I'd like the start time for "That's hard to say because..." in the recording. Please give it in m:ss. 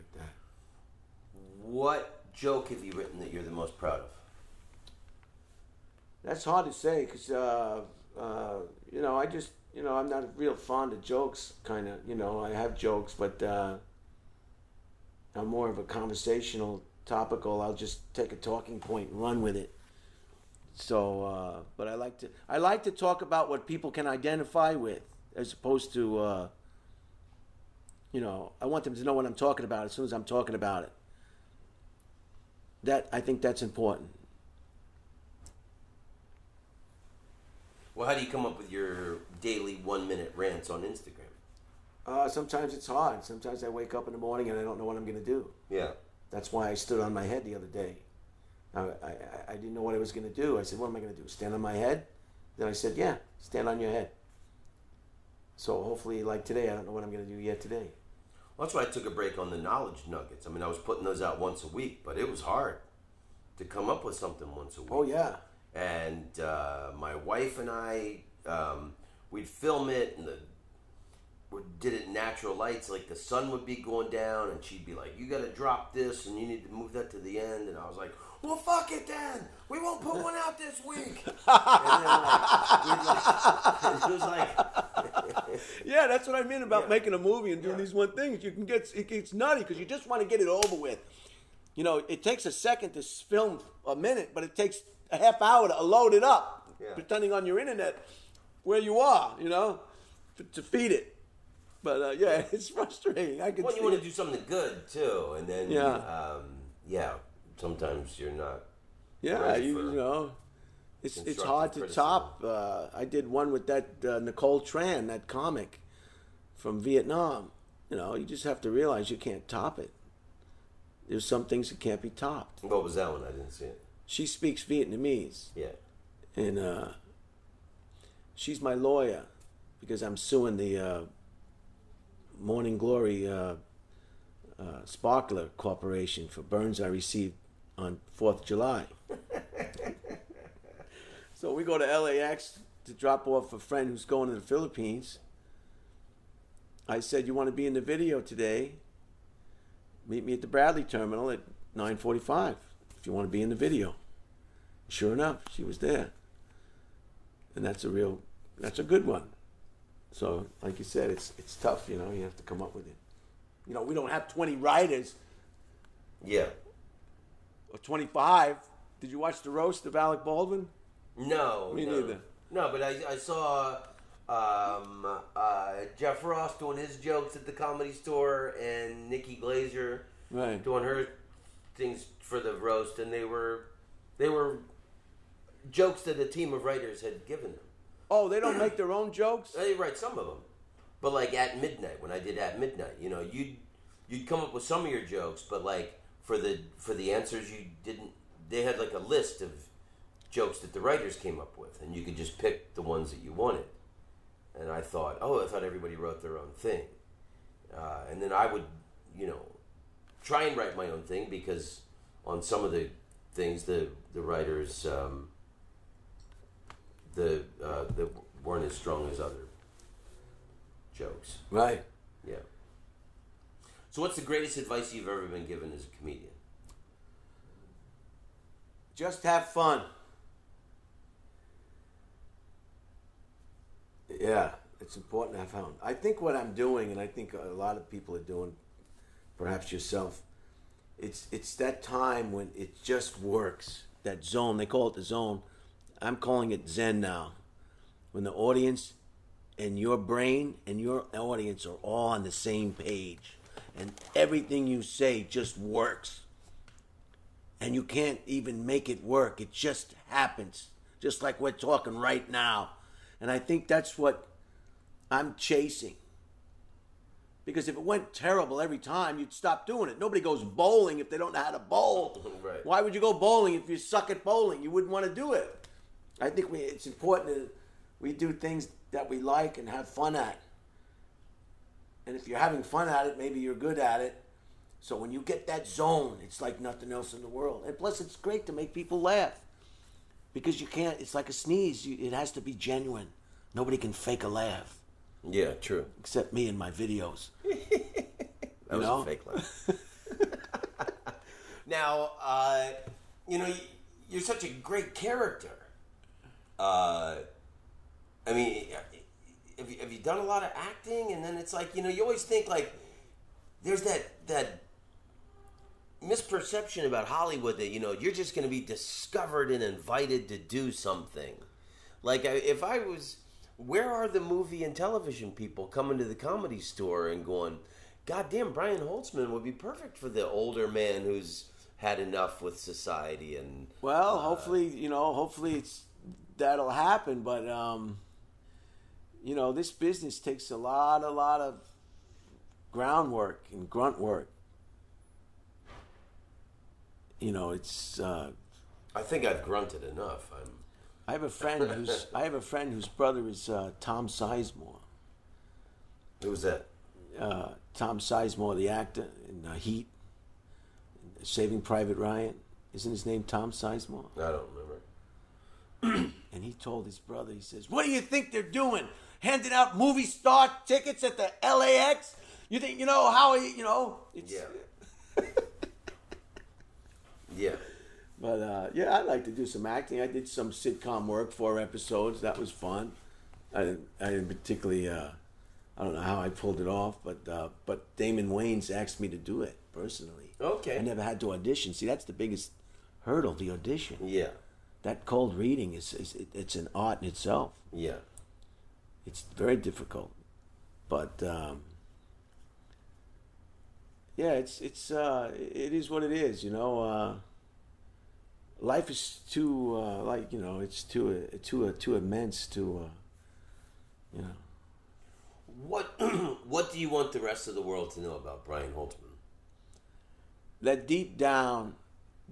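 0:06.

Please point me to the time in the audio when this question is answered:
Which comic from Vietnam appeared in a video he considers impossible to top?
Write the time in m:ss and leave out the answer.
1:54.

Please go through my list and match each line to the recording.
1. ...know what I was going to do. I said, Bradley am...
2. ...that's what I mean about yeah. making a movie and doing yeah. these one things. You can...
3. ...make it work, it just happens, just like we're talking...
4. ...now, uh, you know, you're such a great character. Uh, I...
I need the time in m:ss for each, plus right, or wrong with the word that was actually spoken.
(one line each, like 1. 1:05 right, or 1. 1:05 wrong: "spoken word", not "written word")
1. 0:49 wrong: "What", not "Bradley"
2. 1:26 right
3. 4:18 right
4. 5:01 right.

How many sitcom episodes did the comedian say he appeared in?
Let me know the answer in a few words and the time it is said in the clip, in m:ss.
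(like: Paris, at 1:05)
4, at 6:21.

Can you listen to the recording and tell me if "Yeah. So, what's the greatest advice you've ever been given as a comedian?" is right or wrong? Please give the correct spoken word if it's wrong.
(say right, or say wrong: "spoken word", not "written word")
right.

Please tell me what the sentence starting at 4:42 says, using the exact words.
And if you're having fun at it, maybe you're good at it.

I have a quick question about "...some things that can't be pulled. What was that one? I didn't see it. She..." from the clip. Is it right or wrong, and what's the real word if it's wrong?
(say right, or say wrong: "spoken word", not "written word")
wrong: "topped", not "pulled".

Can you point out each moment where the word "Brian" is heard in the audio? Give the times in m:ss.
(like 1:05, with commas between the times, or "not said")
5:28, 6:58.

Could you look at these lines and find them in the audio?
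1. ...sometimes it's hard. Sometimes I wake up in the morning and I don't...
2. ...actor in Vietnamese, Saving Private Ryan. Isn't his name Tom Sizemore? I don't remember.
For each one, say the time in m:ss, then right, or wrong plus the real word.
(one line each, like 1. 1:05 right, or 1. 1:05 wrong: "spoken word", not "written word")
1. 0:42 right
2. 5:58 wrong: "Heat", not "Vietnamese".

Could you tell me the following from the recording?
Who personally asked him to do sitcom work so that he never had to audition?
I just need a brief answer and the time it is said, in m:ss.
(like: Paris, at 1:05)
Damon Wayans, at 6:27.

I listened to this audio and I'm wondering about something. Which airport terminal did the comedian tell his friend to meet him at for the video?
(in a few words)
Bradley terminal.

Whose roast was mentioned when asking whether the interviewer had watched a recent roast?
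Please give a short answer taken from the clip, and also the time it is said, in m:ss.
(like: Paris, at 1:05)
Alec Baldwin, at 2:49.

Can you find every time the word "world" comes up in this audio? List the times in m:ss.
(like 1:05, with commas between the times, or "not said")
4:47, 6:57.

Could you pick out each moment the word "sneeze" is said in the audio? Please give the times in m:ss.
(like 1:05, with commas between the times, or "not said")
4:51.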